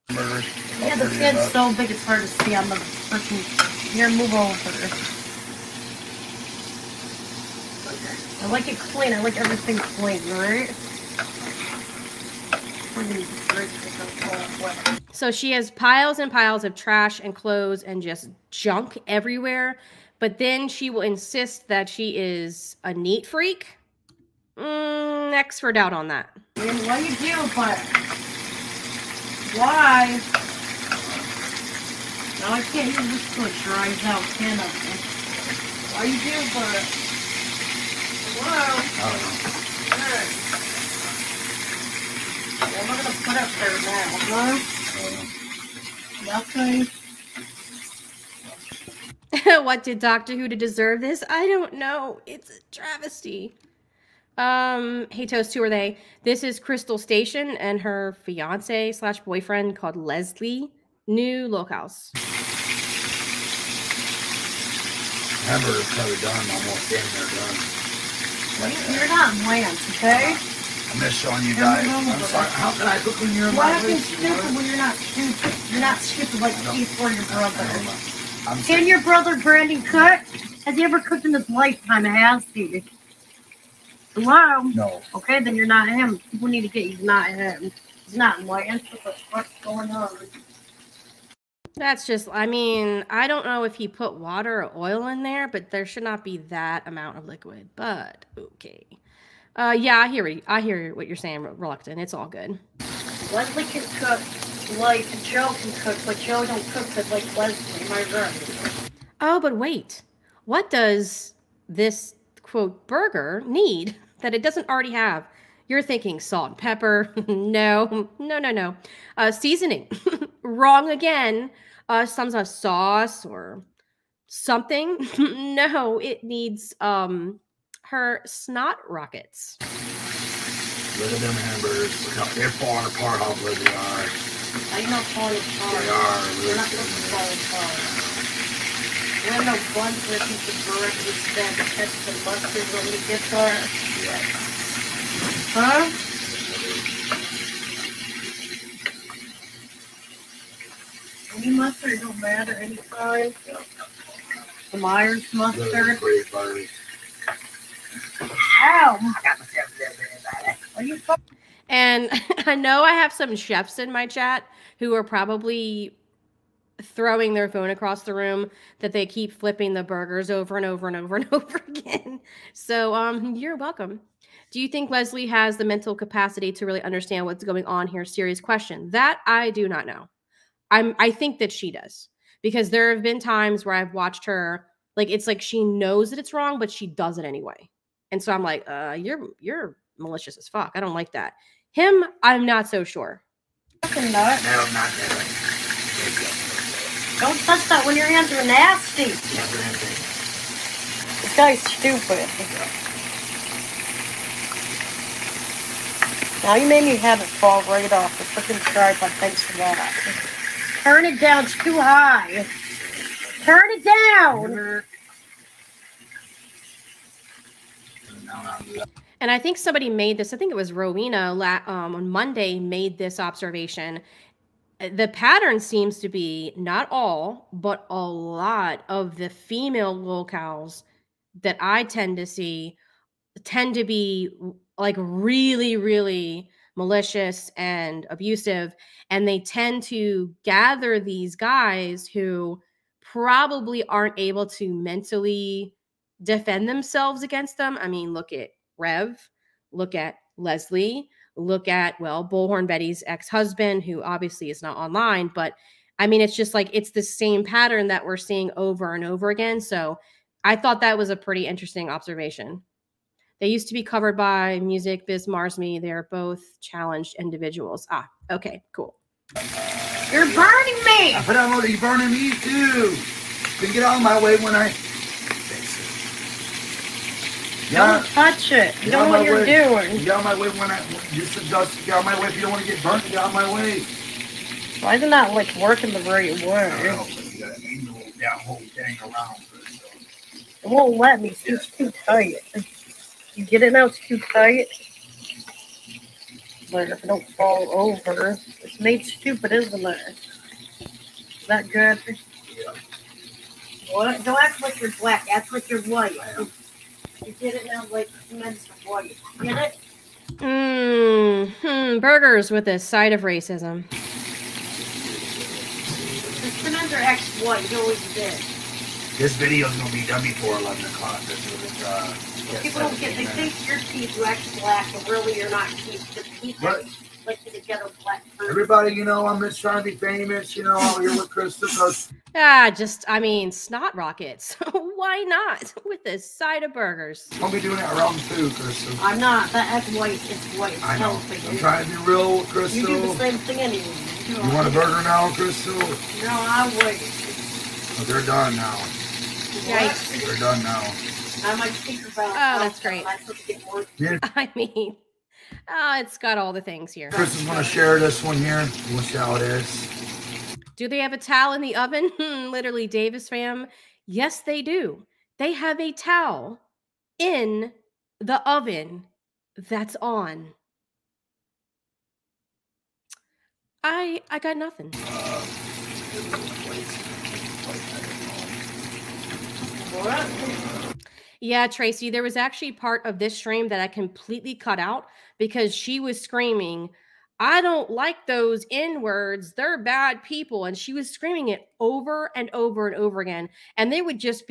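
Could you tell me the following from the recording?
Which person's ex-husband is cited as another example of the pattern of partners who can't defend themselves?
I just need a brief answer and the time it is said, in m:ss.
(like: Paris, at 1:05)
Bullhorn Betty, at 4:12.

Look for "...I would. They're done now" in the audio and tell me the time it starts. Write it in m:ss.
5:46.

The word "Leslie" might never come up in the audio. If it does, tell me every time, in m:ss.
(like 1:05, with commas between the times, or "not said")
0:59, 1:43, 1:47, 2:54, 4:10.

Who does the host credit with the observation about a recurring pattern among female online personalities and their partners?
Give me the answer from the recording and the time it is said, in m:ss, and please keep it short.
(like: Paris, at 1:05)
Rowena, at 3:40.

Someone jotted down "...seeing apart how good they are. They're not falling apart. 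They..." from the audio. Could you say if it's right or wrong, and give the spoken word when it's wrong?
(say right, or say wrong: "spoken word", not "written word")
wrong: "falling", not "seeing".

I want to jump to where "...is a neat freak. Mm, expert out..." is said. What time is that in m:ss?
0:22.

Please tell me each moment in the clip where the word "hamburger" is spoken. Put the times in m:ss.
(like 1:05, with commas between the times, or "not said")
1:05, 2:11.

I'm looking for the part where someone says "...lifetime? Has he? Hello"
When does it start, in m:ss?
1:21.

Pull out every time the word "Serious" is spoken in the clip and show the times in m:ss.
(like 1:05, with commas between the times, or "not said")
2:58.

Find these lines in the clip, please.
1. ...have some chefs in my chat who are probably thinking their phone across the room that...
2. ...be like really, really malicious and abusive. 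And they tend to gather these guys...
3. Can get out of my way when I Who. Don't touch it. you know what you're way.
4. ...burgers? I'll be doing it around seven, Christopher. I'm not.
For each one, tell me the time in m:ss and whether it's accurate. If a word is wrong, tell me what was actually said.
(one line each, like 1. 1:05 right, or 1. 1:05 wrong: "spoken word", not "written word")
1. 2:42 wrong: "throwing", not "thinking"
2. 3:53 right
3. 4:33 wrong: "Yeah", not "Who"
4. 5:36 wrong: "two", not "seven".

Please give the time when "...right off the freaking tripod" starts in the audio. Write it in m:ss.
3:27.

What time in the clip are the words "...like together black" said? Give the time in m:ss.
5:27.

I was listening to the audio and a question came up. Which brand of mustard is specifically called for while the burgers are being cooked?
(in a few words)
Myers.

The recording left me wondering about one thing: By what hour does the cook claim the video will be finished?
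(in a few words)
11 o'clock.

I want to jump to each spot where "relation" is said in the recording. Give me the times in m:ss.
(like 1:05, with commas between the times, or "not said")
not said.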